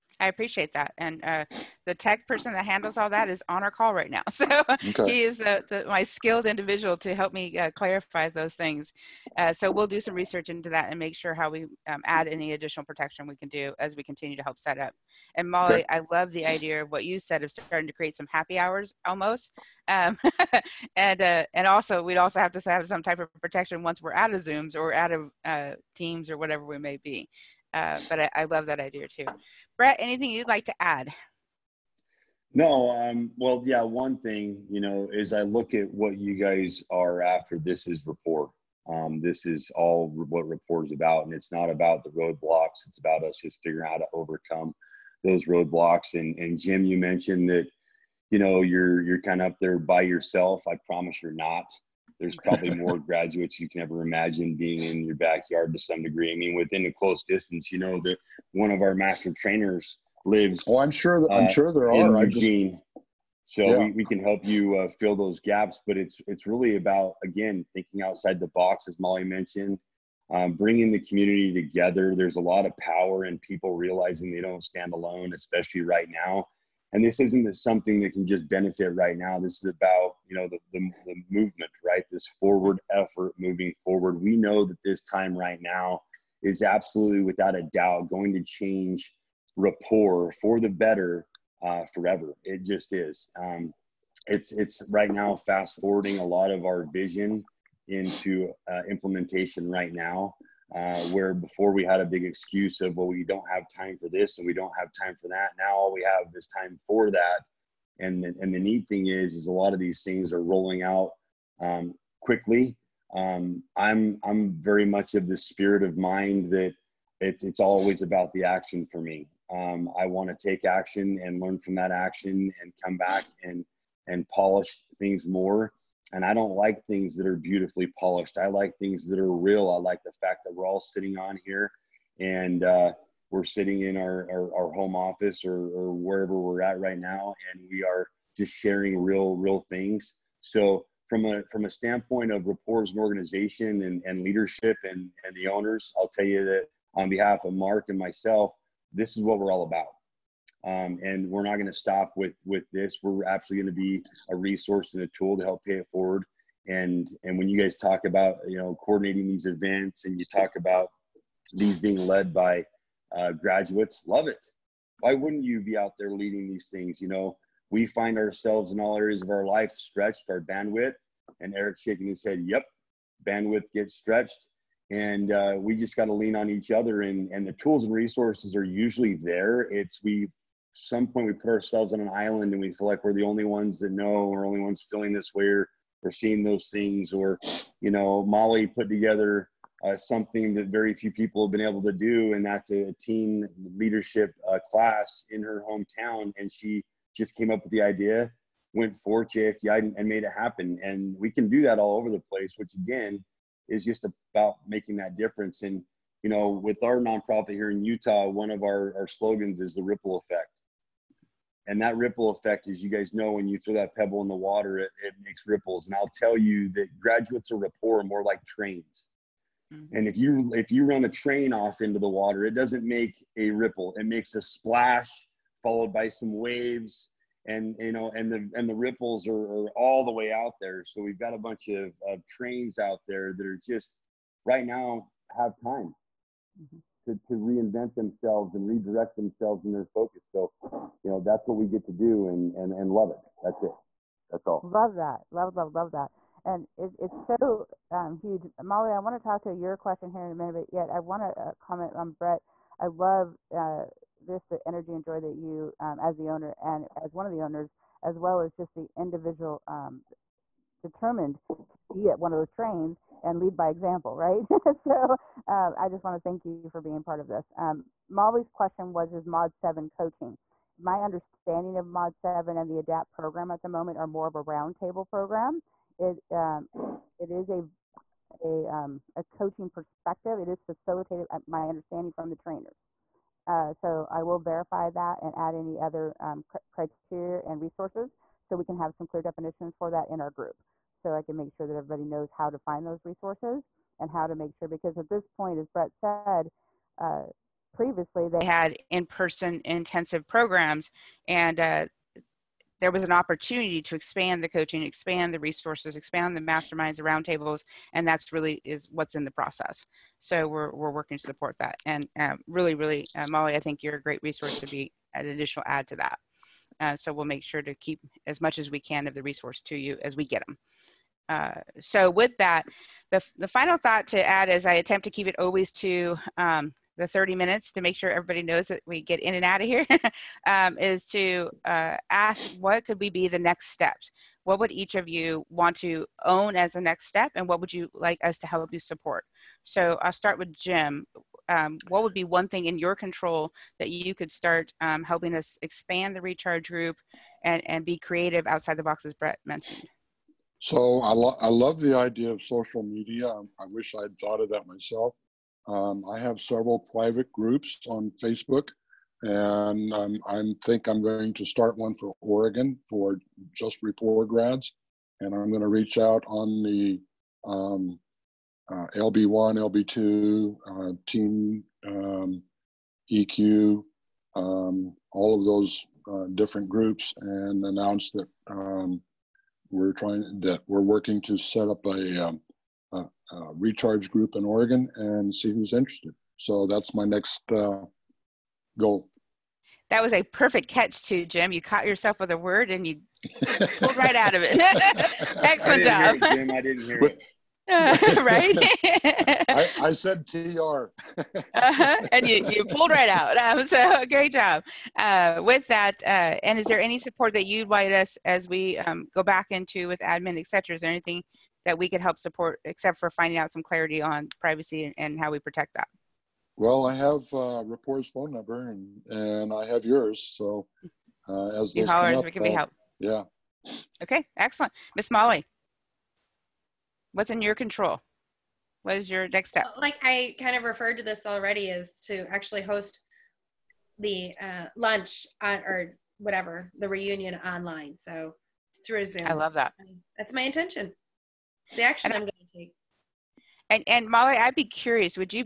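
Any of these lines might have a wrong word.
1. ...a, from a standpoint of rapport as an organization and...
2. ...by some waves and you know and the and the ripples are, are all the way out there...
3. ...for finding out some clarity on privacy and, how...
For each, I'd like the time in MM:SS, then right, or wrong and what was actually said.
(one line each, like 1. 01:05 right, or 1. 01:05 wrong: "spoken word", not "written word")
1. 02:21 right
2. 03:45 right
3. 06:52 right.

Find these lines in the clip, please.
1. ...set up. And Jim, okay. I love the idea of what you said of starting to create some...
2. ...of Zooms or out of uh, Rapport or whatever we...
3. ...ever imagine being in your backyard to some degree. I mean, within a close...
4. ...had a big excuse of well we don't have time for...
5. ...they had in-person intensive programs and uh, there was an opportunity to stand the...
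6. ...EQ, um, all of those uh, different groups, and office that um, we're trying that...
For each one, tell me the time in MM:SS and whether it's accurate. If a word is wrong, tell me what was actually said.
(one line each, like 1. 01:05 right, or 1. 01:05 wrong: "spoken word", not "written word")
1. 00:14 wrong: "Molly", not "Jim"
2. 00:24 wrong: "Teams", not "Rapport"
3. 00:53 right
4. 01:41 right
5. 04:58 wrong: "expand", not "stand"
6. 06:13 wrong: "announce", not "office".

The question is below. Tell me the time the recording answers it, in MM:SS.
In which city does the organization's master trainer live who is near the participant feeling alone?
01:02.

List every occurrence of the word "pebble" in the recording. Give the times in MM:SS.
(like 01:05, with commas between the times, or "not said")
03:33.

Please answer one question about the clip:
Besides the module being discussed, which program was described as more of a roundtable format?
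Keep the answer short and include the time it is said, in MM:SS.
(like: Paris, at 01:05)
ADAPT, at 04:32.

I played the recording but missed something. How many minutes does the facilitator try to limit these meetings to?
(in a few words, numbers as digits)
30.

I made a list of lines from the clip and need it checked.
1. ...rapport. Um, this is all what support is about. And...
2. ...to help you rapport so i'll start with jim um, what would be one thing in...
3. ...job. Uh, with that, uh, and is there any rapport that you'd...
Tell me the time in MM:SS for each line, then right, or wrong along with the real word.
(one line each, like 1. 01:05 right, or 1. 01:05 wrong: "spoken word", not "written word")
1. 00:38 wrong: "rapport", not "support"
2. 05:38 wrong: "support", not "rapport"
3. 06:44 wrong: "support", not "rapport".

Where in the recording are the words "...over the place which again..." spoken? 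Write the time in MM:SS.
03:21.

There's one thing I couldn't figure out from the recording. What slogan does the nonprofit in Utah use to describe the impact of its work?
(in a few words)
The ripple effect.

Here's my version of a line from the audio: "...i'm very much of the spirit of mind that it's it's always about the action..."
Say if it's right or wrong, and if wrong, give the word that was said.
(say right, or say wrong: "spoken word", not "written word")
right.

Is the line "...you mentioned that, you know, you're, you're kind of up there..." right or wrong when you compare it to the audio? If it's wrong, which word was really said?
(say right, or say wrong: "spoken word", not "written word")
right.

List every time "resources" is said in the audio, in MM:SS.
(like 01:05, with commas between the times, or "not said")
02:34, 02:57, 04:47, 04:53, 05:05, 05:14, 05:19.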